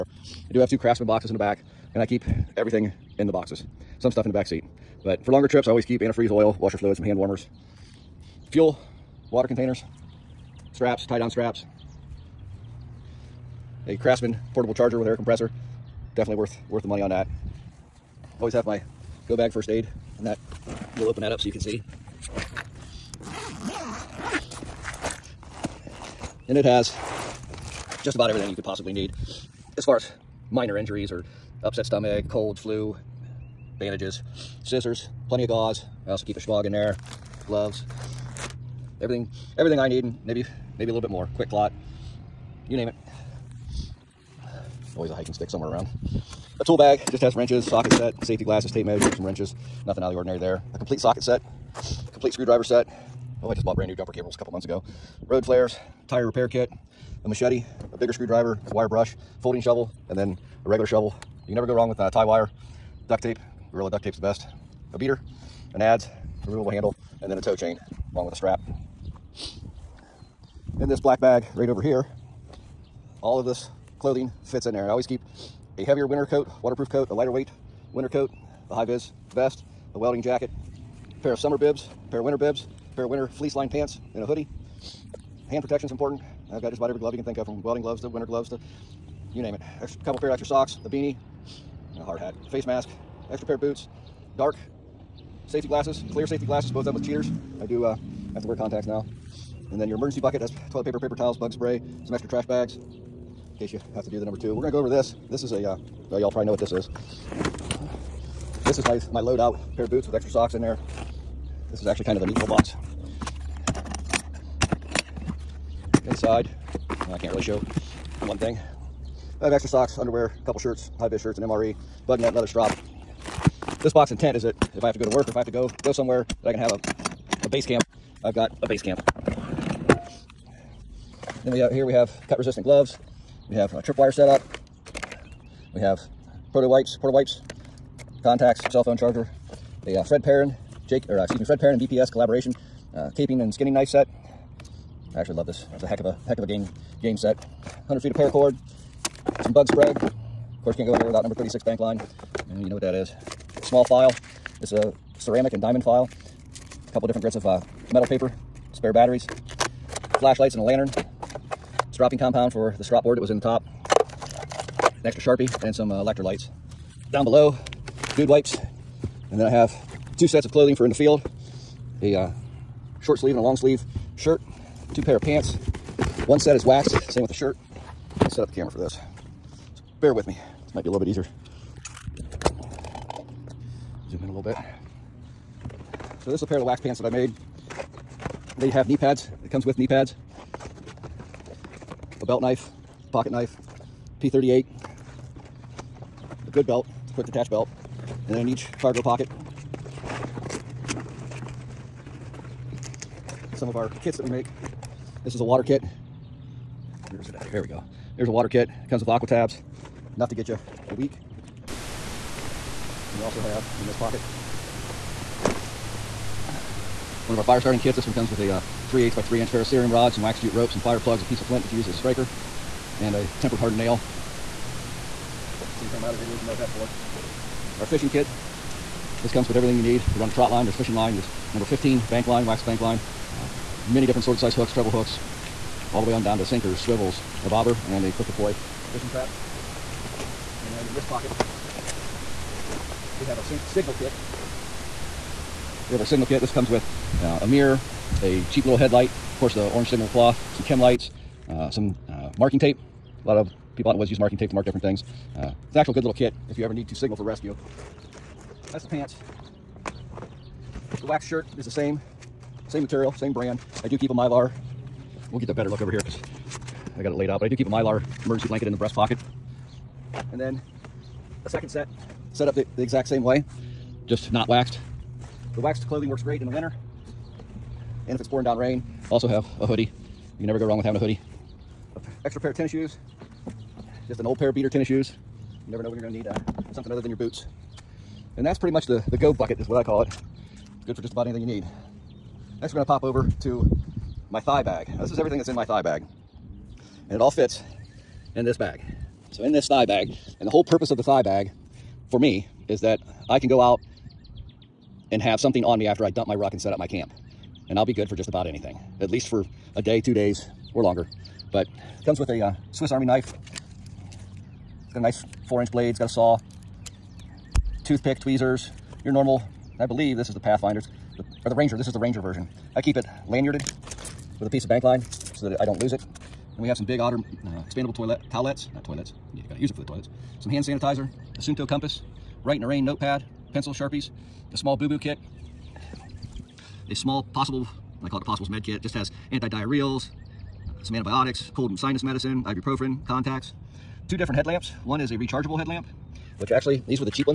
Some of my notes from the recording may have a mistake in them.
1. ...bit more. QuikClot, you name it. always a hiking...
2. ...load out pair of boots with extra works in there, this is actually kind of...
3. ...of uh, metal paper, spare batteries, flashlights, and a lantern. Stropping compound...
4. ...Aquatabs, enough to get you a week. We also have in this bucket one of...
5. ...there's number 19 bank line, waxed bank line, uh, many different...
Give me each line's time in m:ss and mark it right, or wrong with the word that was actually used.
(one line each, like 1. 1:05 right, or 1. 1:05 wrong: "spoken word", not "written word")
1. 0:40 right
2. 1:49 wrong: "socks", not "works"
3. 2:37 right
4. 3:29 wrong: "pocket", not "bucket"
5. 3:51 wrong: "15", not "19".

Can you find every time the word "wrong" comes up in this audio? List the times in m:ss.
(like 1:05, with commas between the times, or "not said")
1:01, 4:40.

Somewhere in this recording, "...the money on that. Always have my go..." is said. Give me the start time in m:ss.
0:16.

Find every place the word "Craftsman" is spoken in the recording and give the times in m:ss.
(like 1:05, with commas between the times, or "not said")
0:00, 0:13.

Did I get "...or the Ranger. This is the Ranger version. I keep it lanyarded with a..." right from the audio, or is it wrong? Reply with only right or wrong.
right.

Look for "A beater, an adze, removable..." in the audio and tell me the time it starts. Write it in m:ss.
1:04.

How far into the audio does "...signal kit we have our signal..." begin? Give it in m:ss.
4:03.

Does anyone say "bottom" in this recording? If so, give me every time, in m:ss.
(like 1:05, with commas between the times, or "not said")
not said.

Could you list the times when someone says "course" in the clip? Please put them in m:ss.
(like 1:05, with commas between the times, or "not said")
2:30, 4:09.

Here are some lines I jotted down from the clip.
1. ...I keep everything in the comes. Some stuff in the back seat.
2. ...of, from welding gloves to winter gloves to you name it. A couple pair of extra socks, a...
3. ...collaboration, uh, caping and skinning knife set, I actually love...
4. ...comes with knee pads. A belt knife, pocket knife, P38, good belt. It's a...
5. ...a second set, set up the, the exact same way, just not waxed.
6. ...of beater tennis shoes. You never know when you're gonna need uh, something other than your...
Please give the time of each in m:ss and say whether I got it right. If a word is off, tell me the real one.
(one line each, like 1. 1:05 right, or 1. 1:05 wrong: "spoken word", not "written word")
1. 0:01 wrong: "boxes", not "comes"
2. 1:27 right
3. 2:22 right
4. 3:09 right
5. 4:31 right
6. 4:44 right.